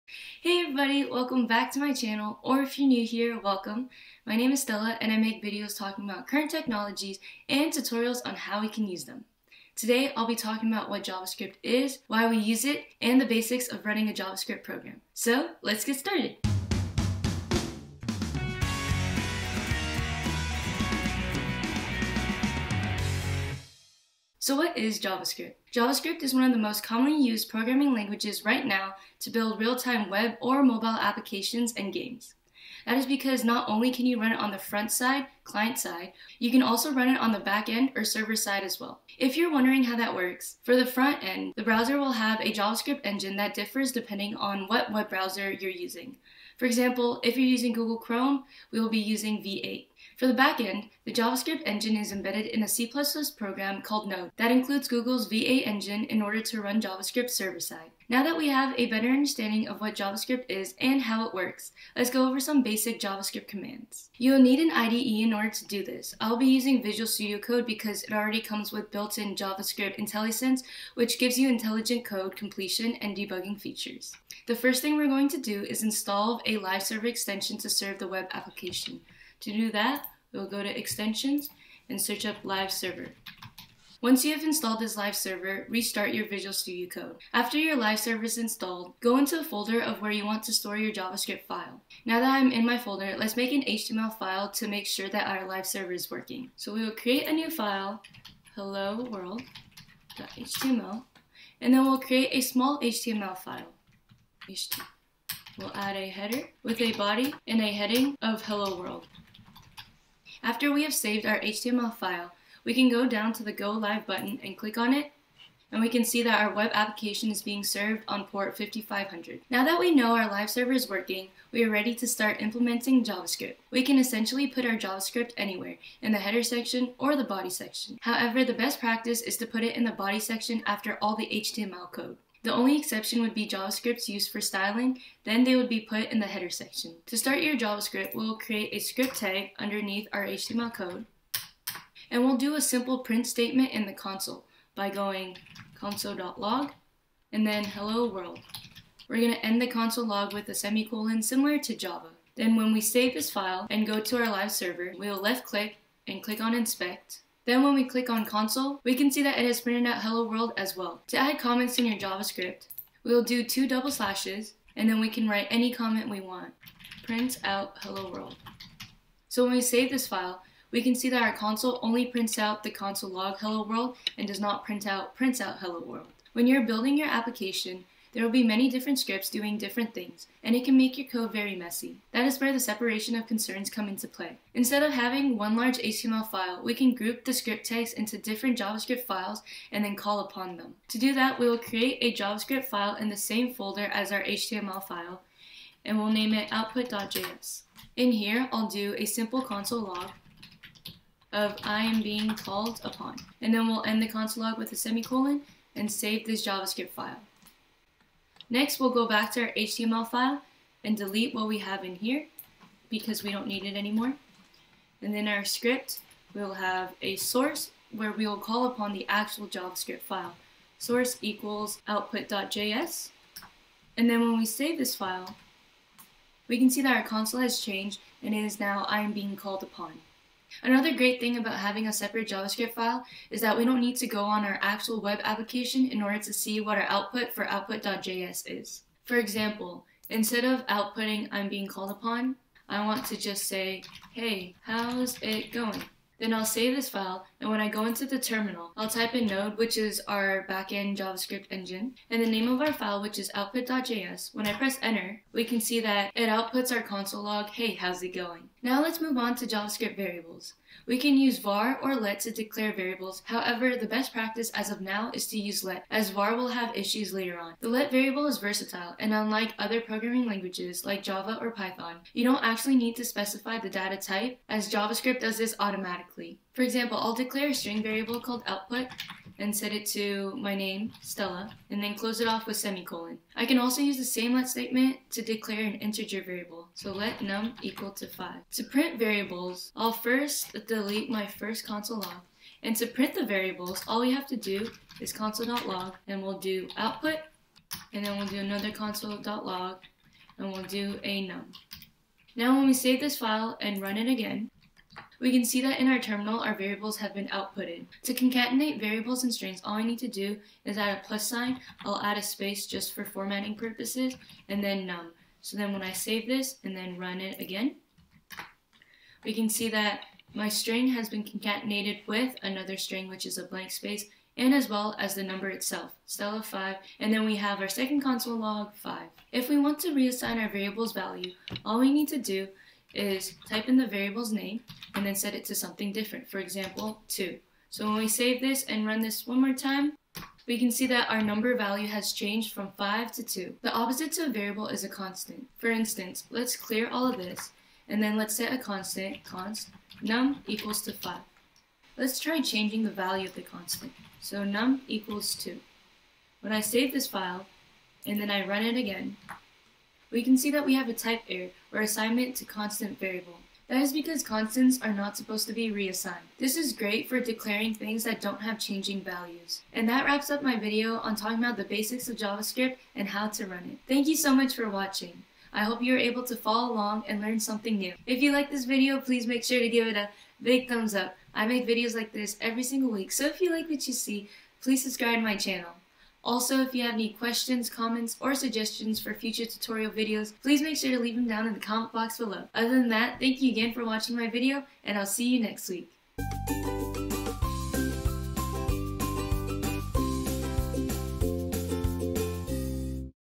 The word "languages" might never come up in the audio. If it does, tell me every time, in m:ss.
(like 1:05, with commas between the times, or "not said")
0:27, 4:30.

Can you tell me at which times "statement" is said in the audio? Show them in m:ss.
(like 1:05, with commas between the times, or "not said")
2:23, 4:44.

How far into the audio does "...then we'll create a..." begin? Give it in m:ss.
1:41.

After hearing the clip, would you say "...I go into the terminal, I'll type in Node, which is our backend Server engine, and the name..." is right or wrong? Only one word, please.
wrong.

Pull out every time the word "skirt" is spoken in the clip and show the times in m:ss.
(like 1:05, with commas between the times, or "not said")
not said.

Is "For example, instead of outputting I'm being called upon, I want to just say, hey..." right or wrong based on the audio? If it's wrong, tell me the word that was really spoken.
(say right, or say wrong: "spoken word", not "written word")
right.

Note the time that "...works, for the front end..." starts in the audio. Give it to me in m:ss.
0:40.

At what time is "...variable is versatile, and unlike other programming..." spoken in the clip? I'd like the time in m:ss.
4:27.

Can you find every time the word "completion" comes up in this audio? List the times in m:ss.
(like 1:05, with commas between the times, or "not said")
1:12.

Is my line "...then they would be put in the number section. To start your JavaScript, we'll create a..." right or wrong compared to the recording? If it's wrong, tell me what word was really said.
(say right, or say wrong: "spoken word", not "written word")
wrong: "header", not "number".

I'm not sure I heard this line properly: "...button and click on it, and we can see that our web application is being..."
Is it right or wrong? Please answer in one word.
right.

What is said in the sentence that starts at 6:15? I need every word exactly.
I hope you are able to follow along and learn something new.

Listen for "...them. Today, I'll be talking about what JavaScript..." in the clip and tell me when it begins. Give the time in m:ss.
0:09.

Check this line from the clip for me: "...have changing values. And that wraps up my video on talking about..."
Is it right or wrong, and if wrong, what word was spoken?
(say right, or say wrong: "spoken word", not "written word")
right.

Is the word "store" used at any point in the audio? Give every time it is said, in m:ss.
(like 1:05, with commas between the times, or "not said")
1:30.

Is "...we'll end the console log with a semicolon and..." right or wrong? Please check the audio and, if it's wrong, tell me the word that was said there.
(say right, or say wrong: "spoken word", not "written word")
right.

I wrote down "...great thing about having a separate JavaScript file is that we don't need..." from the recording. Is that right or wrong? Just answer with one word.
right.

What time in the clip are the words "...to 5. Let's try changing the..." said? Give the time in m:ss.
5:50.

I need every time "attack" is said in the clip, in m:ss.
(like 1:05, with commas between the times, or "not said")
not said.